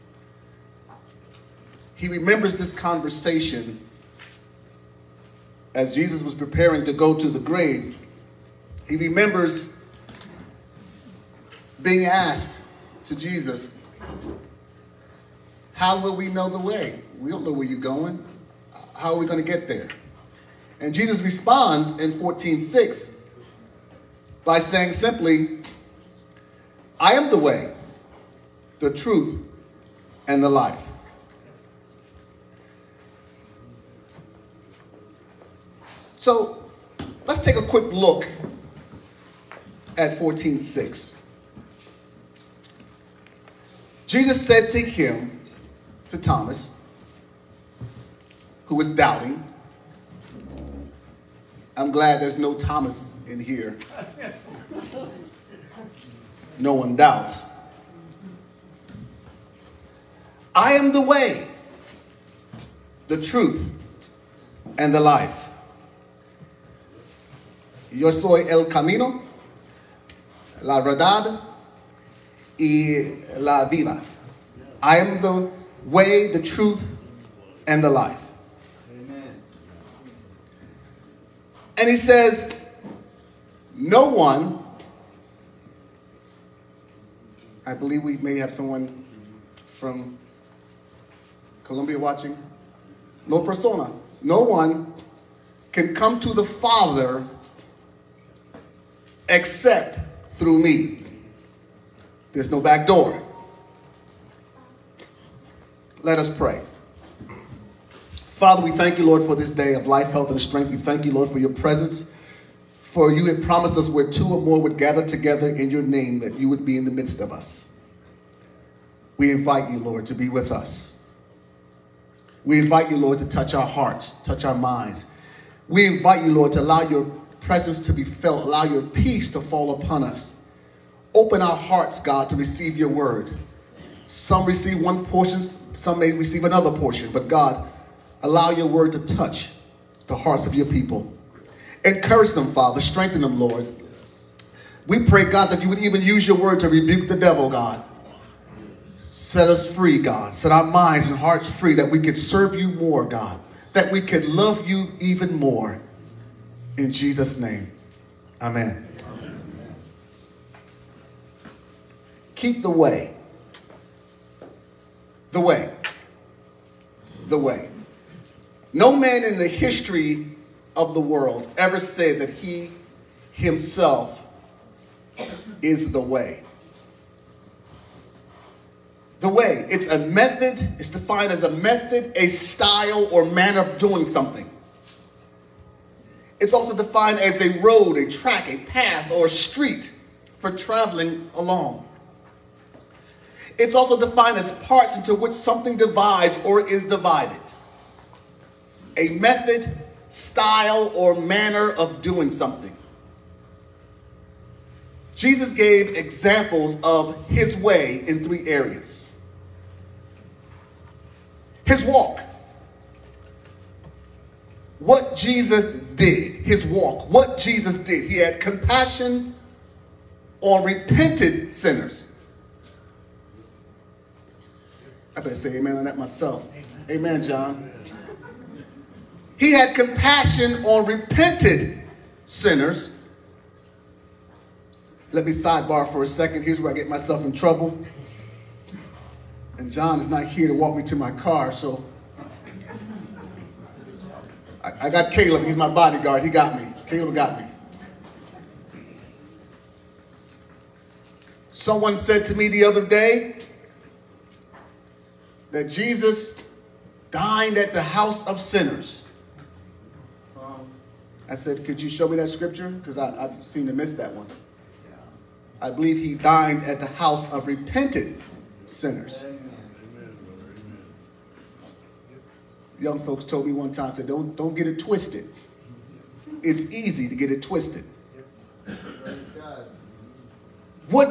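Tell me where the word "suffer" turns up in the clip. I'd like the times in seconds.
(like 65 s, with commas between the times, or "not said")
not said.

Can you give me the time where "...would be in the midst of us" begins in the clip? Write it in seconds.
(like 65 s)
116 s.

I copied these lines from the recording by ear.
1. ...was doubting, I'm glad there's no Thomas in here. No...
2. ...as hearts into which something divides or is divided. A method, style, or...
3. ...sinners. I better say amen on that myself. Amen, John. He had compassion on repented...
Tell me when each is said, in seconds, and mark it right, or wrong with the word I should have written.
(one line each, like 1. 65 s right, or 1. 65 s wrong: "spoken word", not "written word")
1. 48 s right
2. 194 s wrong: "parts", not "hearts"
3. 221 s right.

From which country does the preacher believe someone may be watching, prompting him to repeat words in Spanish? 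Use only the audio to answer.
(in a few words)
Colombia.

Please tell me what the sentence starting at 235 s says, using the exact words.
Let me sidebar for a second.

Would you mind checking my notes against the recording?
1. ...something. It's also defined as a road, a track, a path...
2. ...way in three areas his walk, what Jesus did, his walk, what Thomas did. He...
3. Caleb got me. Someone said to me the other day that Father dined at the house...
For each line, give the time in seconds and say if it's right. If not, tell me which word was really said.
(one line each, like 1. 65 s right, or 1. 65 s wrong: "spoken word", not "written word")
1. 184 s right
2. 207 s wrong: "Jesus", not "Thomas"
3. 246 s wrong: "Jesus", not "Father".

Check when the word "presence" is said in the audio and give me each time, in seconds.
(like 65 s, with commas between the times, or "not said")
111 s, 127 s.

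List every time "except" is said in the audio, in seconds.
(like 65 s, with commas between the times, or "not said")
99 s.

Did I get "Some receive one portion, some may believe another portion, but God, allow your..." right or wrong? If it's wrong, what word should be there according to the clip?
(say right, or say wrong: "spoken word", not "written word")
wrong: "receive", not "believe".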